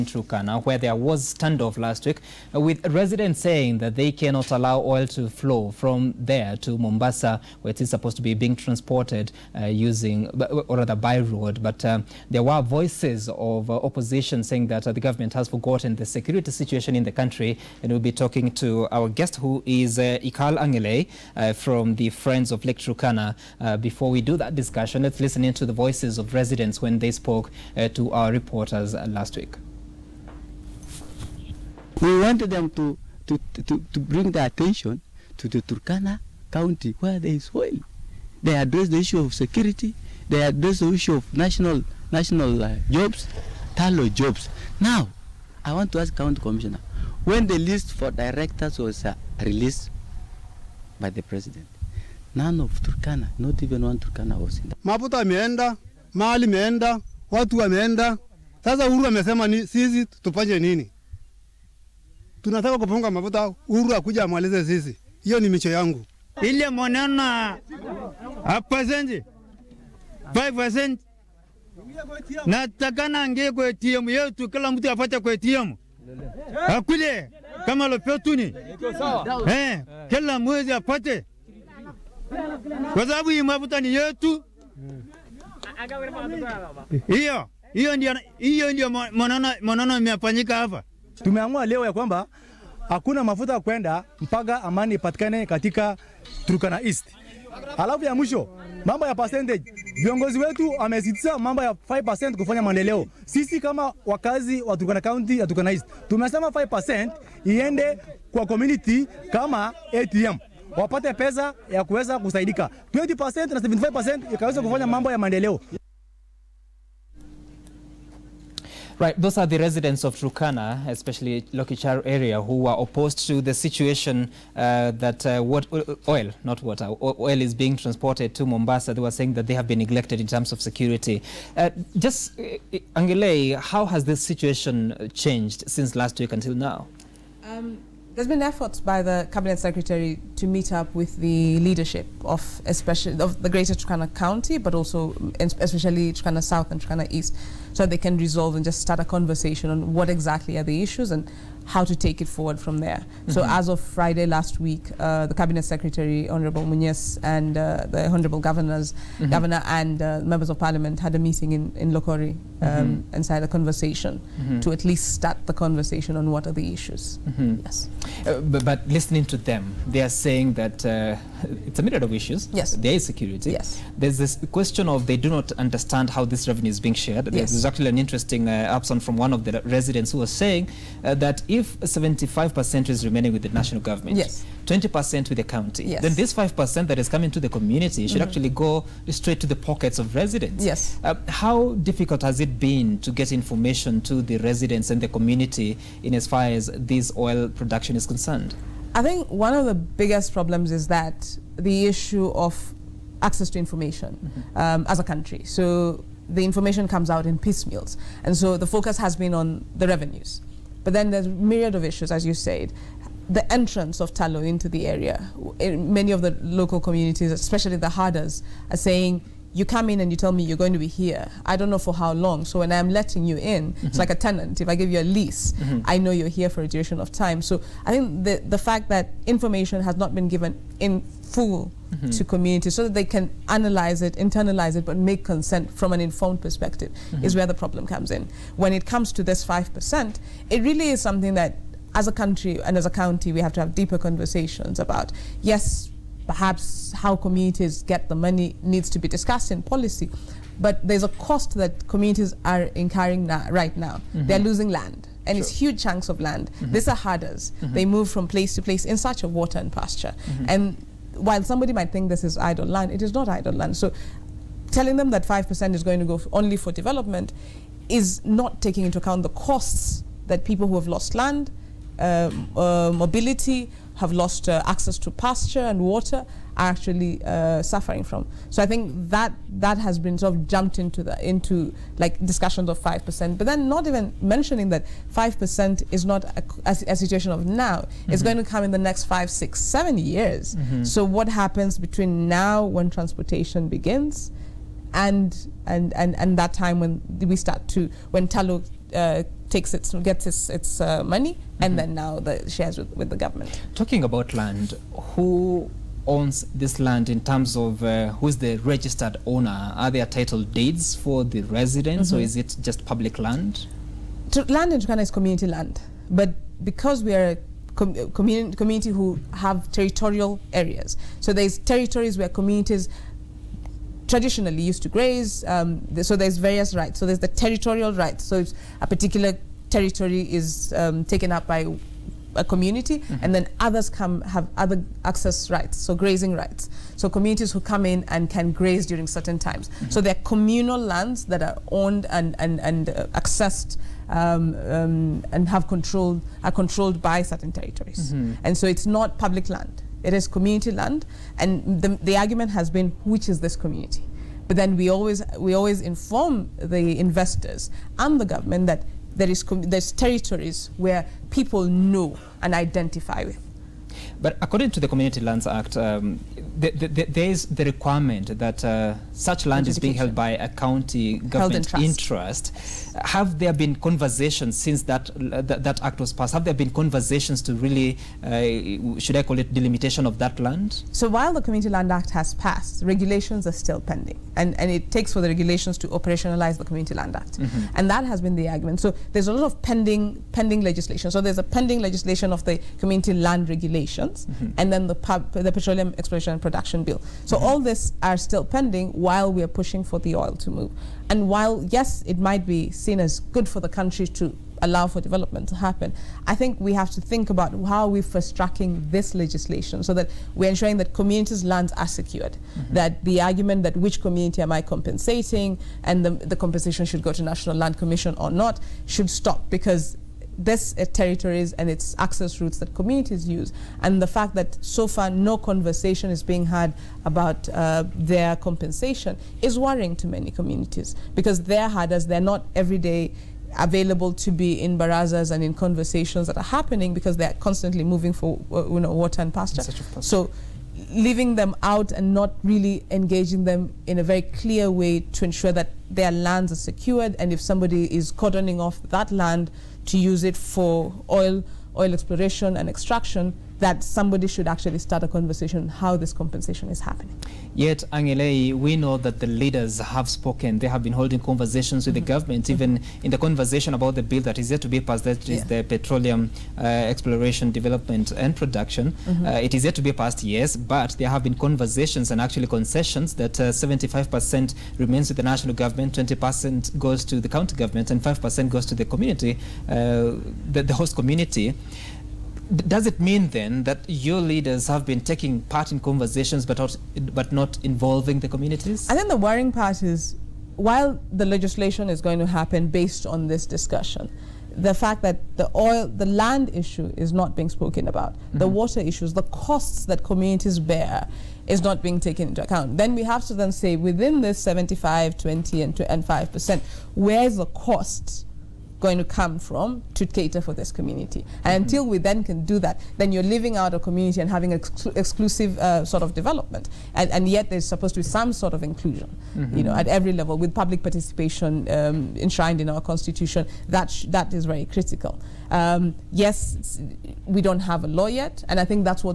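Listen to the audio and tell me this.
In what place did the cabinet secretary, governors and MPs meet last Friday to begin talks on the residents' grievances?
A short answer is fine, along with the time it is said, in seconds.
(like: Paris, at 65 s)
Lokori, at 161 s.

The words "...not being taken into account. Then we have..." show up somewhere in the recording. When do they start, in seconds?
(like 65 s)
501 s.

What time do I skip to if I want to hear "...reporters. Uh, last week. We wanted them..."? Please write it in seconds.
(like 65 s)
28 s.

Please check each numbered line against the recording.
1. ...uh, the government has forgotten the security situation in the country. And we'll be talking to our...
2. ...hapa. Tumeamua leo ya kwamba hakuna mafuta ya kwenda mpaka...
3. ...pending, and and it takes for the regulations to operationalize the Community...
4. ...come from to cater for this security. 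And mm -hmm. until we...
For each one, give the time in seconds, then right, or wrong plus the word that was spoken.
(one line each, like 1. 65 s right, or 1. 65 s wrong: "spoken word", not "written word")
1. 14 s right
2. 90 s right
3. 383 s right
4. 509 s wrong: "community", not "security".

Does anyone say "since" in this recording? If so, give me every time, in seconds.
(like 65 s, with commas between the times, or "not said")
135 s, 374 s.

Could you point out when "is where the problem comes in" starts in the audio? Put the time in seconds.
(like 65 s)
237 s.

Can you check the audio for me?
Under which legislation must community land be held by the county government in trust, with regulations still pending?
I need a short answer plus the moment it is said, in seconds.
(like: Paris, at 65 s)
Community Lands Act, at 364 s.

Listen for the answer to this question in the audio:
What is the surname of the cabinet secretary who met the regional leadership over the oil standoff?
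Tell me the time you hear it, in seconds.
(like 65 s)
156 s.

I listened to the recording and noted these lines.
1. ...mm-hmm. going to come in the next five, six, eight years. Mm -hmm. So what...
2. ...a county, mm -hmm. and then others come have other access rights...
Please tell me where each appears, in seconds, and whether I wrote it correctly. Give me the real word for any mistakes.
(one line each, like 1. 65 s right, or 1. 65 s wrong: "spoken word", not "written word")
1. 288 s wrong: "seven", not "eight"
2. 332 s wrong: "community", not "county".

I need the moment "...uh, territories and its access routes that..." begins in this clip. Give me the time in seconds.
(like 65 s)
420 s.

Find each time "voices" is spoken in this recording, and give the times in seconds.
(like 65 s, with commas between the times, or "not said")
12 s, 25 s.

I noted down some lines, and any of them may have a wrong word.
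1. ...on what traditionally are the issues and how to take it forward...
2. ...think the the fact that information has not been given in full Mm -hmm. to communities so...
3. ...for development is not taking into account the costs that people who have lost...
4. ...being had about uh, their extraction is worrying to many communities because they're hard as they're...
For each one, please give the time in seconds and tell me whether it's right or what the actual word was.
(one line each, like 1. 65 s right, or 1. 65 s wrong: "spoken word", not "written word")
1. 149 s wrong: "exactly", not "traditionally"
2. 227 s right
3. 266 s right
4. 426 s wrong: "compensation", not "extraction".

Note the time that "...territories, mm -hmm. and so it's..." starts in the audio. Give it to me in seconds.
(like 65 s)
347 s.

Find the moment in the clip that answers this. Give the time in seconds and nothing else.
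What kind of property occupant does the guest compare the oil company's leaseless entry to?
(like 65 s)
224 s.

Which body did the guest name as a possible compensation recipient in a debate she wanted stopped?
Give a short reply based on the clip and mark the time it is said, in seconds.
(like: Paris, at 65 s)
National Land Commission, at 417 s.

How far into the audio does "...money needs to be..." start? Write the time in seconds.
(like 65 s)
248 s.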